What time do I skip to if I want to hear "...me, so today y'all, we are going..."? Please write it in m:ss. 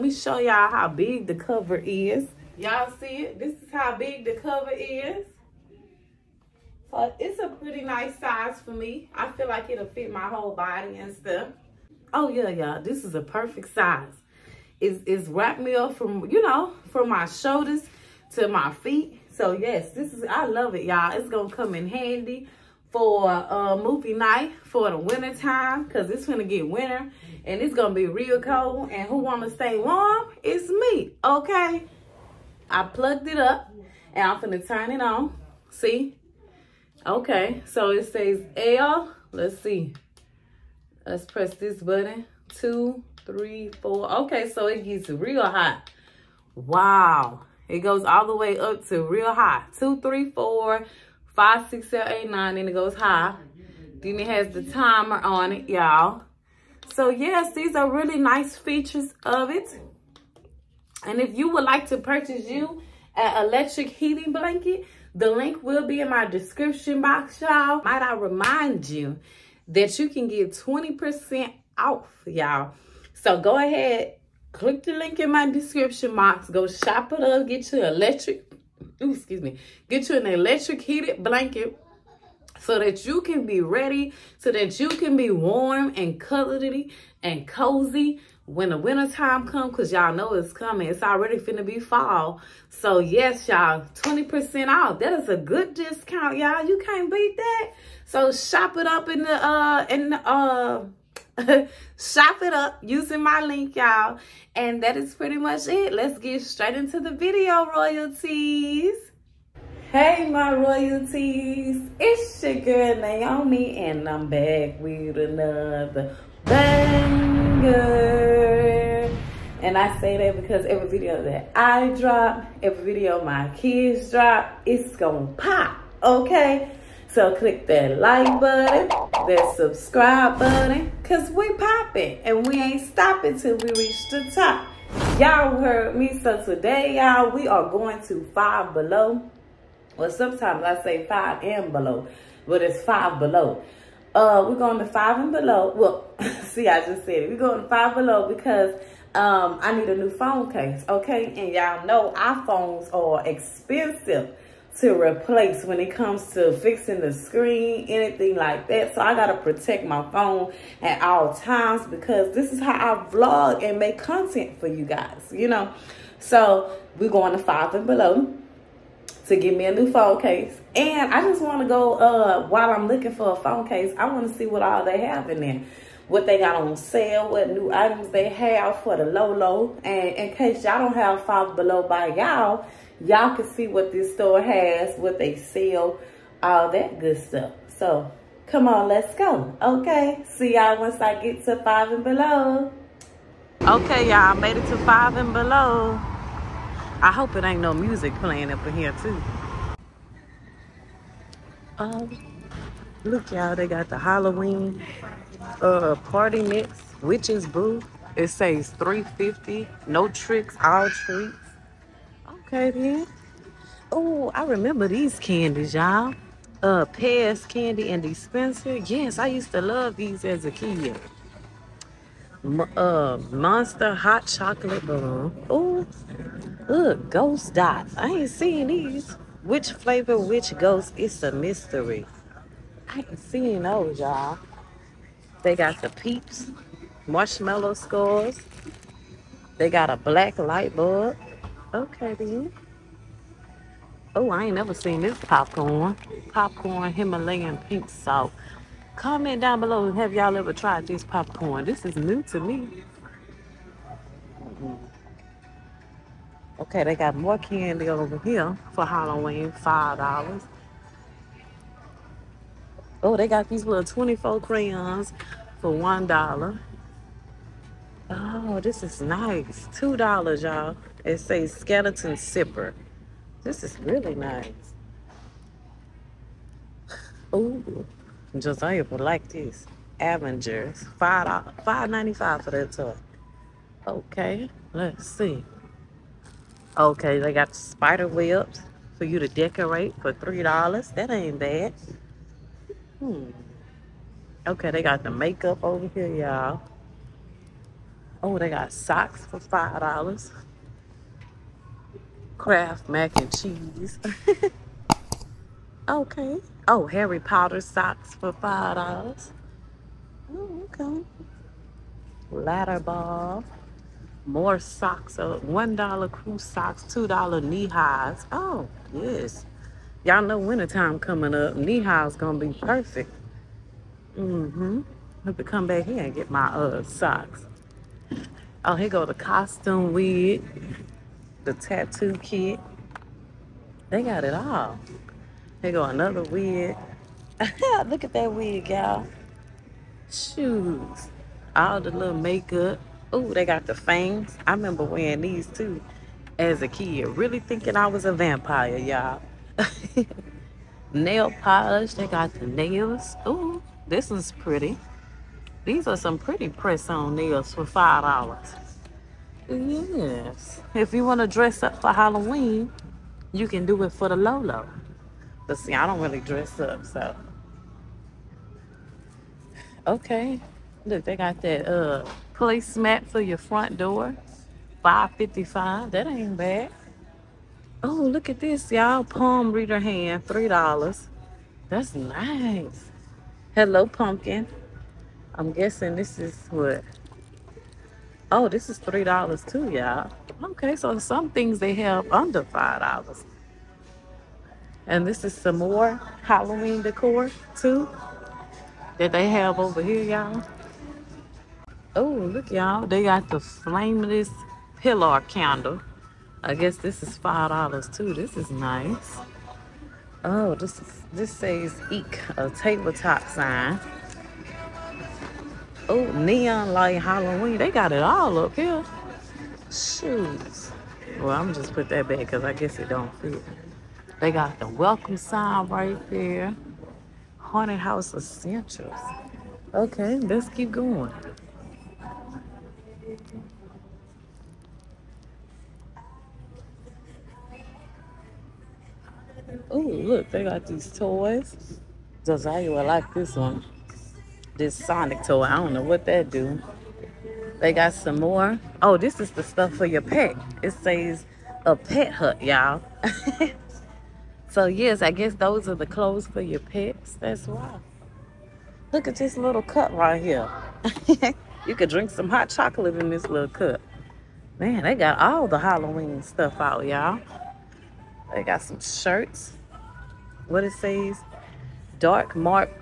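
2:15.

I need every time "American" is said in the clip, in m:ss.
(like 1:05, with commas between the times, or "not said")
not said.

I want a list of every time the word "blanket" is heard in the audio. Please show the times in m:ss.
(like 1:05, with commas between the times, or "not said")
1:04, 1:21.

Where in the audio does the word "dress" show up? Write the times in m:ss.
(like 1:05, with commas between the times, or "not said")
6:01, 6:06.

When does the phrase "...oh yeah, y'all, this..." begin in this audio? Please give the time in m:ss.
0:12.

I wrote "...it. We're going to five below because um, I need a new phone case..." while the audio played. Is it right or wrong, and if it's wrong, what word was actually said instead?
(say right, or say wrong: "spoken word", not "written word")
right.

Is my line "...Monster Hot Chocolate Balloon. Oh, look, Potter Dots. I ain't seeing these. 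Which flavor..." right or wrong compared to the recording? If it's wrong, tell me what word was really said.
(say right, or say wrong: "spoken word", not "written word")
wrong: "Ghost", not "Potter".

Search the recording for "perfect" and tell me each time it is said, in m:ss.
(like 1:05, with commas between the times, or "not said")
0:13, 5:22.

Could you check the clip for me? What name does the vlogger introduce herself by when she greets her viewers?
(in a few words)
Naiome.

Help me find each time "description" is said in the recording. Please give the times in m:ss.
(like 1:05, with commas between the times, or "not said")
1:06, 1:15.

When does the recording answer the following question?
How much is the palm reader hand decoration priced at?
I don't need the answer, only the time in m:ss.
6:19.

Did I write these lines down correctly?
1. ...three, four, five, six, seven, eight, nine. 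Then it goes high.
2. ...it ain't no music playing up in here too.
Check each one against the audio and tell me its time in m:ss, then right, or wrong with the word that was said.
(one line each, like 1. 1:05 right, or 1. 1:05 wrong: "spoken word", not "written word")
1. 0:49 right
2. 3:17 right.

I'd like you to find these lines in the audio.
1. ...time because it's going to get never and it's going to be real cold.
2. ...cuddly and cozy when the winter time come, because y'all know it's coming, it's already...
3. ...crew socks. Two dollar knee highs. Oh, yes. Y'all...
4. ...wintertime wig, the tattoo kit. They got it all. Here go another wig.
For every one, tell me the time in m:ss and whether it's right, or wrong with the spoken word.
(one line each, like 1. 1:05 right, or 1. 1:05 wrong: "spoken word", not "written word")
1. 0:25 wrong: "winter", not "never"
2. 1:26 right
3. 5:16 right
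4. 5:29 wrong: "costume", not "wintertime".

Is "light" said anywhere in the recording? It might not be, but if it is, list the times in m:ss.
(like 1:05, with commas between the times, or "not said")
4:00, 6:56.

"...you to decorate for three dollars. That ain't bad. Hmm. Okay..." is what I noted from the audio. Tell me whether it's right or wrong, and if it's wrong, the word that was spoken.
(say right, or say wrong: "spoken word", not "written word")
right.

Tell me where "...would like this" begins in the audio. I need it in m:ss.
4:38.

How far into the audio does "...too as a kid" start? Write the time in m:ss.
5:45.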